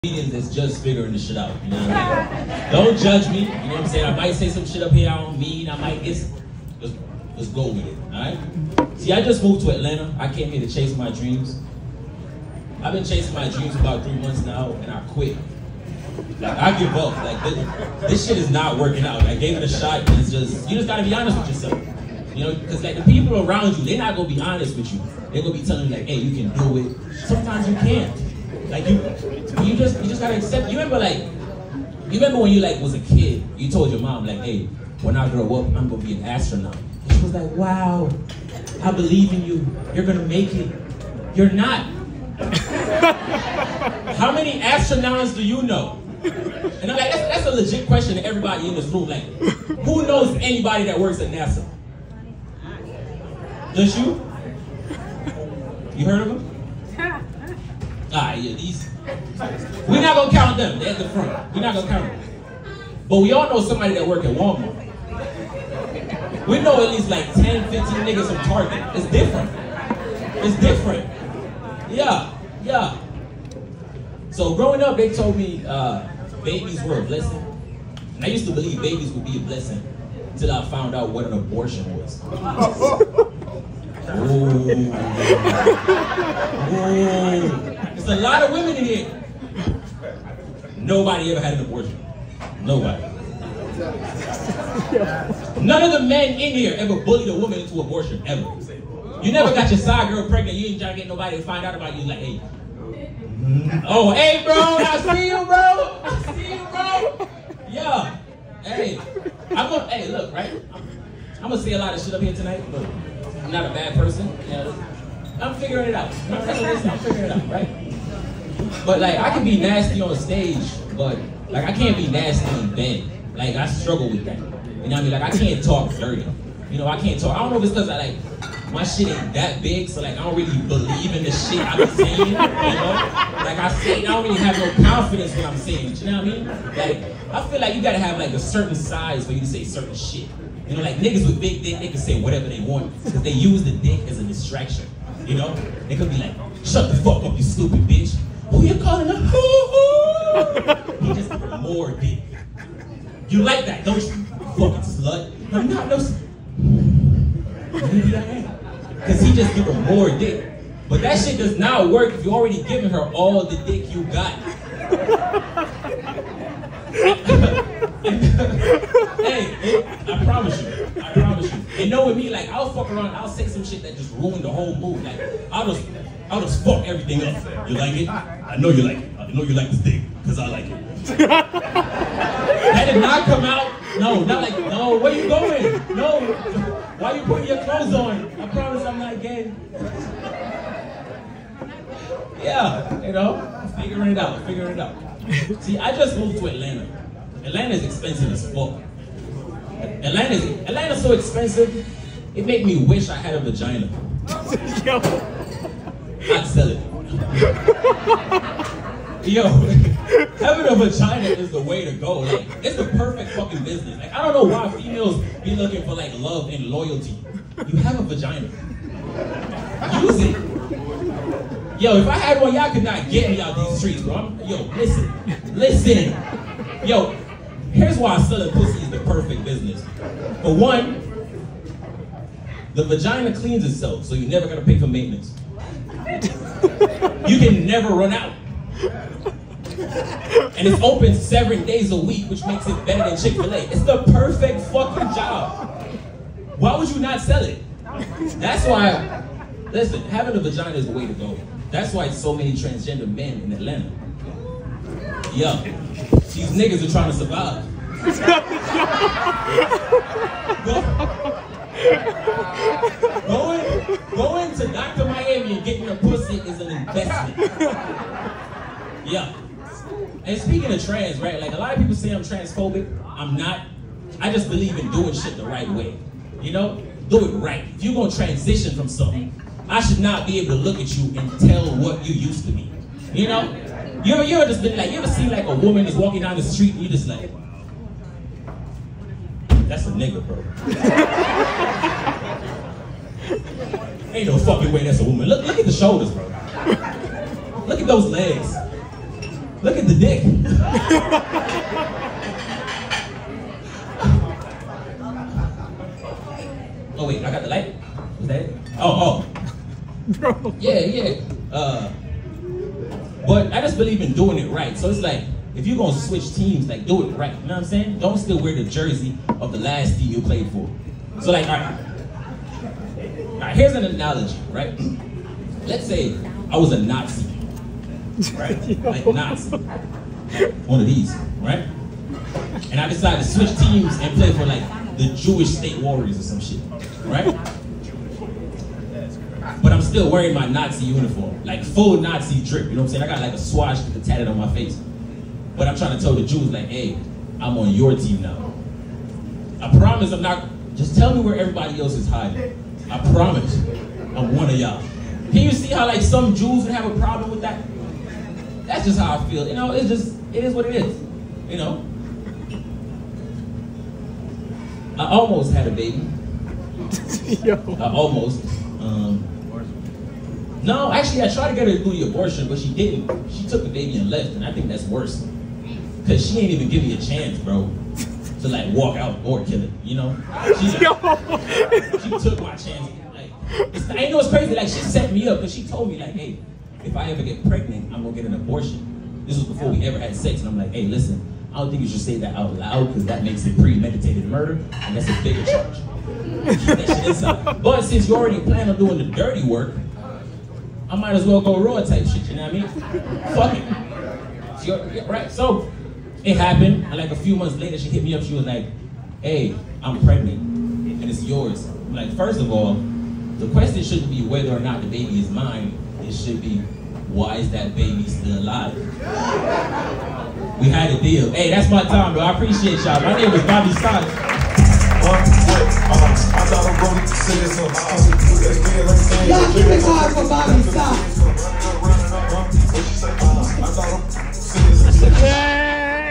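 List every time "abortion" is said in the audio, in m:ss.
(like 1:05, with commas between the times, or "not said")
1:21, 1:31, 1:37, 6:12, 6:28.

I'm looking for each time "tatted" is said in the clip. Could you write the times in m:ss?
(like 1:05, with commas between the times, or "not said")
5:44.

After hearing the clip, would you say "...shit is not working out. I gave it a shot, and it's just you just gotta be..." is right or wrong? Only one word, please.
right.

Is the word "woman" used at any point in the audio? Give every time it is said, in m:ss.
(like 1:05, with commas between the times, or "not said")
1:37, 4:45, 4:55.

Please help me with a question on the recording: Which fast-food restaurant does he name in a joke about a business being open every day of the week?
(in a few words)
Chick-fil-A.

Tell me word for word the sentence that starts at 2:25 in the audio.
You know, they could be like, "Shut the fuck up, you stupid bitch." Who you calling a hoo hoo?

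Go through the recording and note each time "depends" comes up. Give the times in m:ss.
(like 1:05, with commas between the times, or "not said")
not said.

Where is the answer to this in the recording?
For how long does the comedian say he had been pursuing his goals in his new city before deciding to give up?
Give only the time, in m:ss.
0:14.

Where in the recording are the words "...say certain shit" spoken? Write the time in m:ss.
2:19.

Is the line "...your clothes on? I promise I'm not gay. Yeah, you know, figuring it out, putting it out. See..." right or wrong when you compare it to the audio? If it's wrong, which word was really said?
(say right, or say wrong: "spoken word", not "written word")
wrong: "figuring", not "putting".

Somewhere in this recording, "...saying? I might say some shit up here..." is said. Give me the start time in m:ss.
0:03.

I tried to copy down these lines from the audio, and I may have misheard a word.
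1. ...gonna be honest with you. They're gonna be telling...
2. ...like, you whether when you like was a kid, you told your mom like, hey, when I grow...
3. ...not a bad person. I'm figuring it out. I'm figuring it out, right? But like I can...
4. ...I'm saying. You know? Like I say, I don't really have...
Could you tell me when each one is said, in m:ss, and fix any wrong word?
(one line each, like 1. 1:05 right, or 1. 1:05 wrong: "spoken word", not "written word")
1. 0:24 right
2. 0:30 wrong: "remember", not "whether"
3. 1:53 right
4. 2:11 right.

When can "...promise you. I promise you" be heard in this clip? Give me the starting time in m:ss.
2:50.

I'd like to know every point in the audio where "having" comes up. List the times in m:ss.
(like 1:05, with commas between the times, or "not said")
3:30, 4:10.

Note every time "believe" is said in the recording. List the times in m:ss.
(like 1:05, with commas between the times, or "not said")
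0:38, 1:18, 2:10, 4:34, 5:13.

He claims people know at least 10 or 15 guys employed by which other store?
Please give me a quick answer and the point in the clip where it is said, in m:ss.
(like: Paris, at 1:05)
Target, at 1:08.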